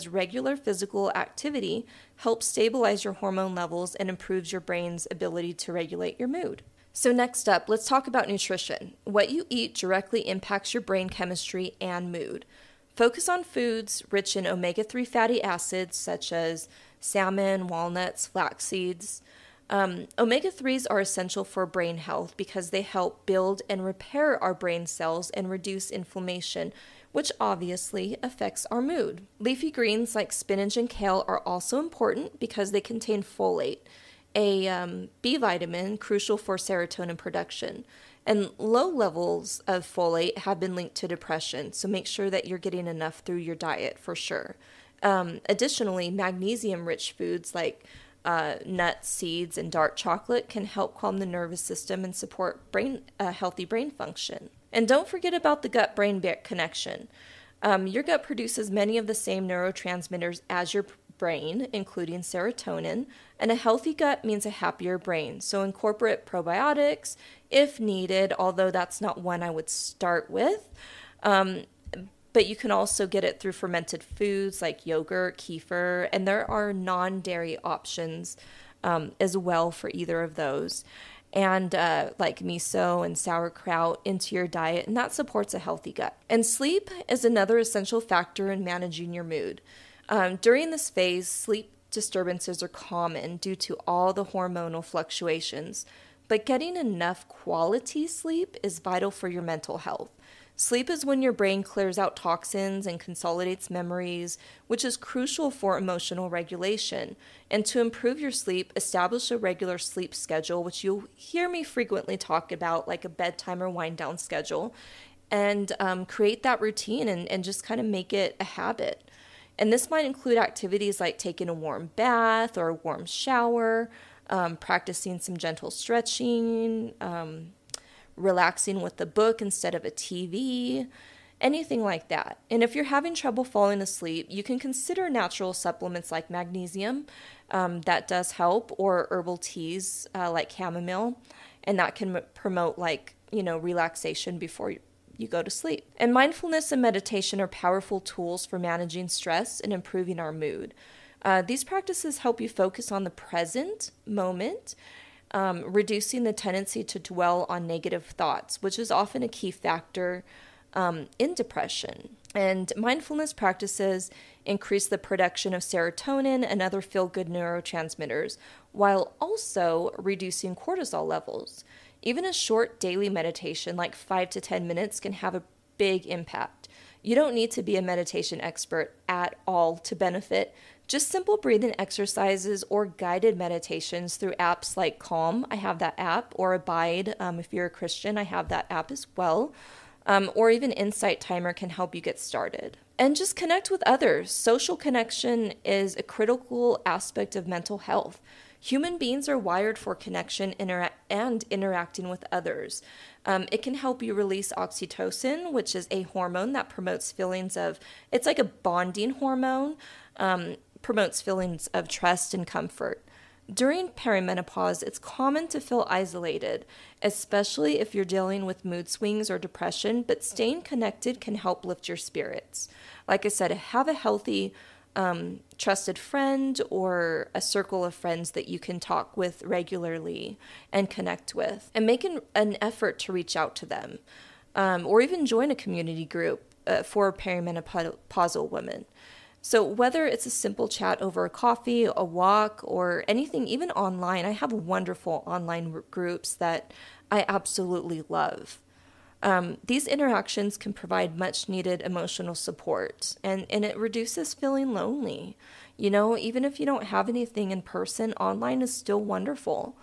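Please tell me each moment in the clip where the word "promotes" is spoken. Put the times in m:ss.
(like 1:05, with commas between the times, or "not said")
2:22, 3:26, 3:30.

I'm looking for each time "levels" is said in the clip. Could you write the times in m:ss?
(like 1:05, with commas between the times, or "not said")
0:03, 0:38, 2:51.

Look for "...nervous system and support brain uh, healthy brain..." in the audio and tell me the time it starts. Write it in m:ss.
0:51.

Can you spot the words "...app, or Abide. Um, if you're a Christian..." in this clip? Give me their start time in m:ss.
3:05.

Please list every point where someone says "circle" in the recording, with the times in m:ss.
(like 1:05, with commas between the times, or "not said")
3:47.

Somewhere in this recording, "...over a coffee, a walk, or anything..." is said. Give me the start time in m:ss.
4:01.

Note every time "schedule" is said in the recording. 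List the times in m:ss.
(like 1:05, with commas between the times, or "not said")
1:50, 1:54.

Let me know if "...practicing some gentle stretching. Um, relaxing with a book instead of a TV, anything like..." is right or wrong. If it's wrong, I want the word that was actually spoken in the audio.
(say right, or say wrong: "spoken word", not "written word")
right.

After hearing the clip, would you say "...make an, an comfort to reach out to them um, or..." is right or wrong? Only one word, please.
wrong.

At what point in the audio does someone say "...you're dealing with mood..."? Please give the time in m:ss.
3:37.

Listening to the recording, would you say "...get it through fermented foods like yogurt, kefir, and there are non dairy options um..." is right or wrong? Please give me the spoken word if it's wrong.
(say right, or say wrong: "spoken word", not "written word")
right.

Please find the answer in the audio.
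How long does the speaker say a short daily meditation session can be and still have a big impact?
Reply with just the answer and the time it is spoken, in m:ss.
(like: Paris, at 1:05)
5 to 10 minutes, at 2:53.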